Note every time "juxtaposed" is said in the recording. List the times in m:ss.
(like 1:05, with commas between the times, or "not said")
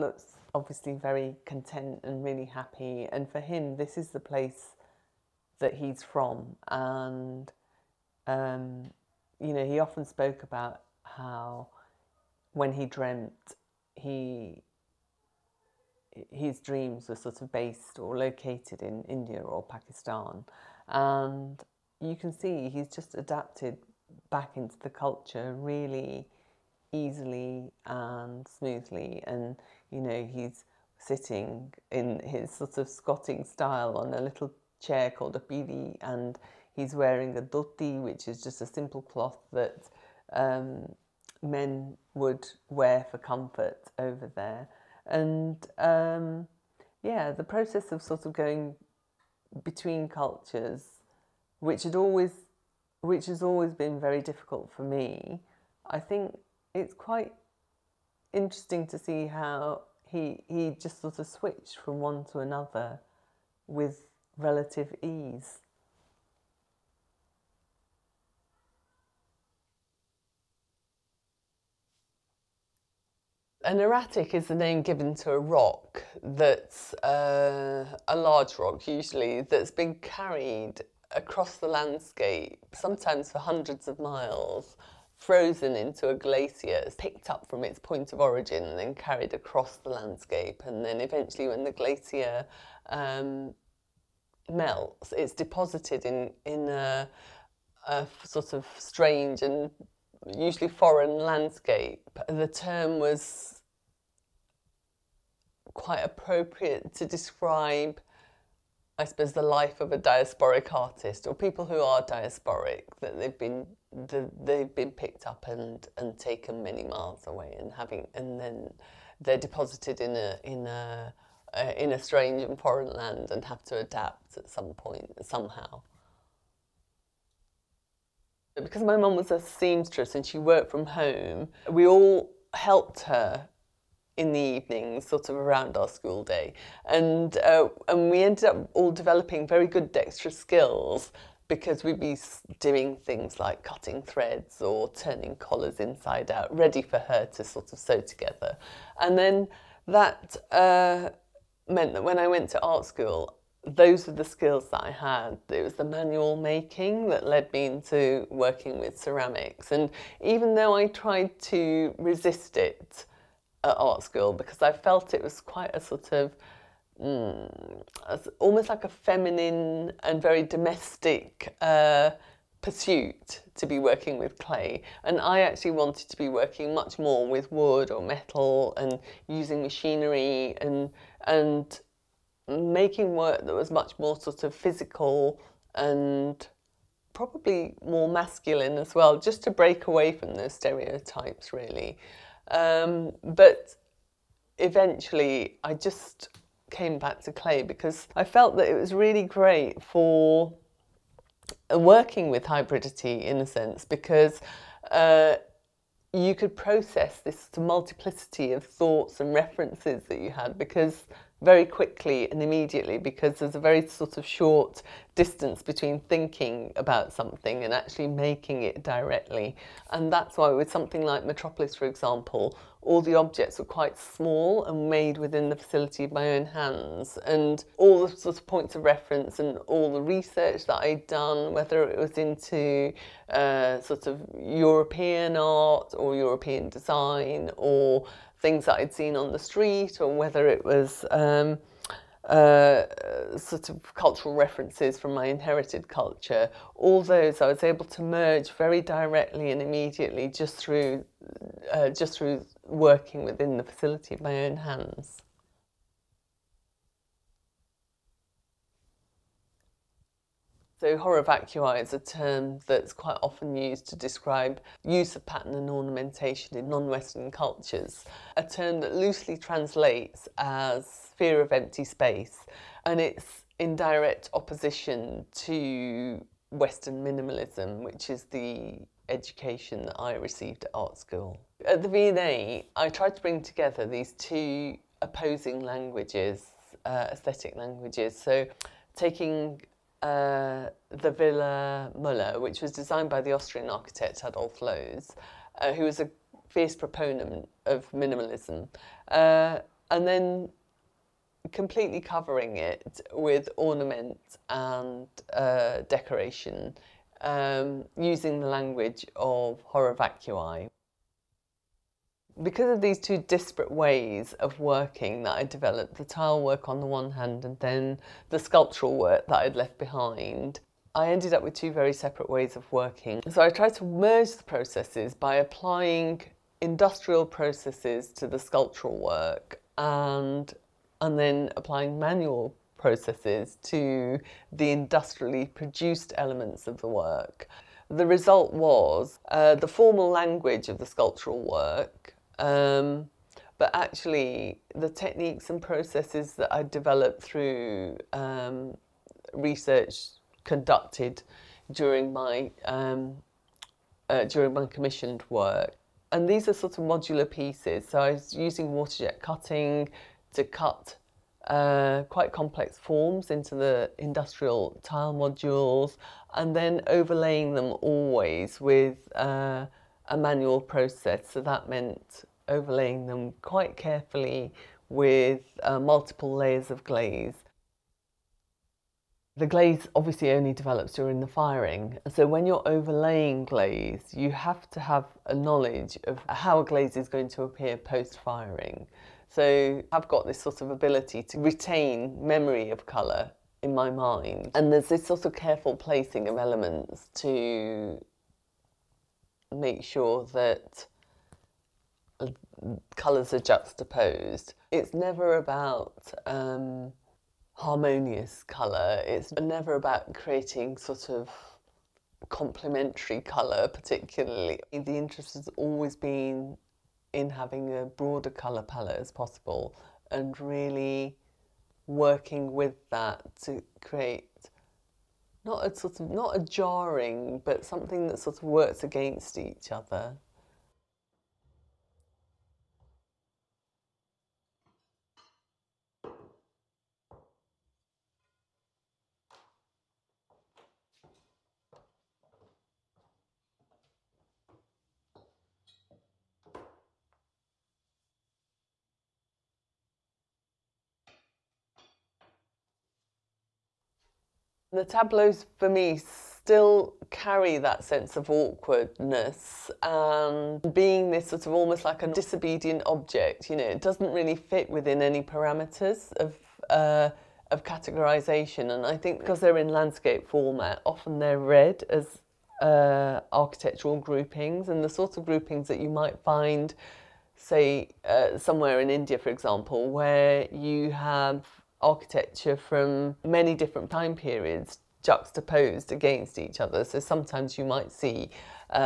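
6:43, 8:05.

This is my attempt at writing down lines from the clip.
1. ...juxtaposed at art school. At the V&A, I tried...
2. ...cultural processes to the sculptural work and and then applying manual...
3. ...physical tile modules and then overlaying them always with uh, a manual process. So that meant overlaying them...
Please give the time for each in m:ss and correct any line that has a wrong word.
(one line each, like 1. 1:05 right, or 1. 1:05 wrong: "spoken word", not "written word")
1. 4:40 wrong: "received", not "juxtaposed"
2. 5:26 wrong: "industrial", not "cultural"
3. 6:03 wrong: "industrial", not "physical".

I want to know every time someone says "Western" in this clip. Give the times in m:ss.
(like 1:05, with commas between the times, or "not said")
4:26, 4:36.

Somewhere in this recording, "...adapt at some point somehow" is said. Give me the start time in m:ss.
2:03.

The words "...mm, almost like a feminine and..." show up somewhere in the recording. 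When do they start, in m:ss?
2:47.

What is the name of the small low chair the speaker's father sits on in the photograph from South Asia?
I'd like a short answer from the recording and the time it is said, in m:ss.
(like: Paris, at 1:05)
pidi, at 0:35.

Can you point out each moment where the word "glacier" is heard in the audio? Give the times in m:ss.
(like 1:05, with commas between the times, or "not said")
1:26, 1:31.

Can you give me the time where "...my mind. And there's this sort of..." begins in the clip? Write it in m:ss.
6:33.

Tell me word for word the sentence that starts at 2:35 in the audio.
It was the manual making that led me into working with ceramics.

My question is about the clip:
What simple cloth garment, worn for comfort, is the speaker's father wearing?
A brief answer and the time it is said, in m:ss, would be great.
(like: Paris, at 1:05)
dhoti, at 0:37.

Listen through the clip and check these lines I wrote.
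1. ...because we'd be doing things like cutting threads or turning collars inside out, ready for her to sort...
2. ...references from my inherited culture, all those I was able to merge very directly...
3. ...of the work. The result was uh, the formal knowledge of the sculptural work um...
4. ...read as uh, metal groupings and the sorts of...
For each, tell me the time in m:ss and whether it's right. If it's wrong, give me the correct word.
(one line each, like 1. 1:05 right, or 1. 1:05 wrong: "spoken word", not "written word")
1. 2:21 right
2. 4:04 right
3. 5:36 wrong: "language", not "knowledge"
4. 7:51 wrong: "architectural", not "metal".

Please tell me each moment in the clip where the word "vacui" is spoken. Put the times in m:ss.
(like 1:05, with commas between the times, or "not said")
4:21, 5:09.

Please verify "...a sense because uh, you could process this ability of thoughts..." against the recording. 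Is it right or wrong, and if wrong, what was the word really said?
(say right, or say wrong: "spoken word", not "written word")
wrong: "multiplicity", not "ability".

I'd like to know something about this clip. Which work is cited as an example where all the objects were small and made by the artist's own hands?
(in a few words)
Metropolis.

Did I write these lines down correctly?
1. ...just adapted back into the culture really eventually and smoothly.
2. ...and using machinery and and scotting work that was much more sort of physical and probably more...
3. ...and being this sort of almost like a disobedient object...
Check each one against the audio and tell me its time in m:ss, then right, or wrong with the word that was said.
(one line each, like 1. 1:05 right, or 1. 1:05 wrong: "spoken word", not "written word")
1. 0:22 wrong: "easily", not "eventually"
2. 2:58 wrong: "making", not "scotting"
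3. 7:39 right.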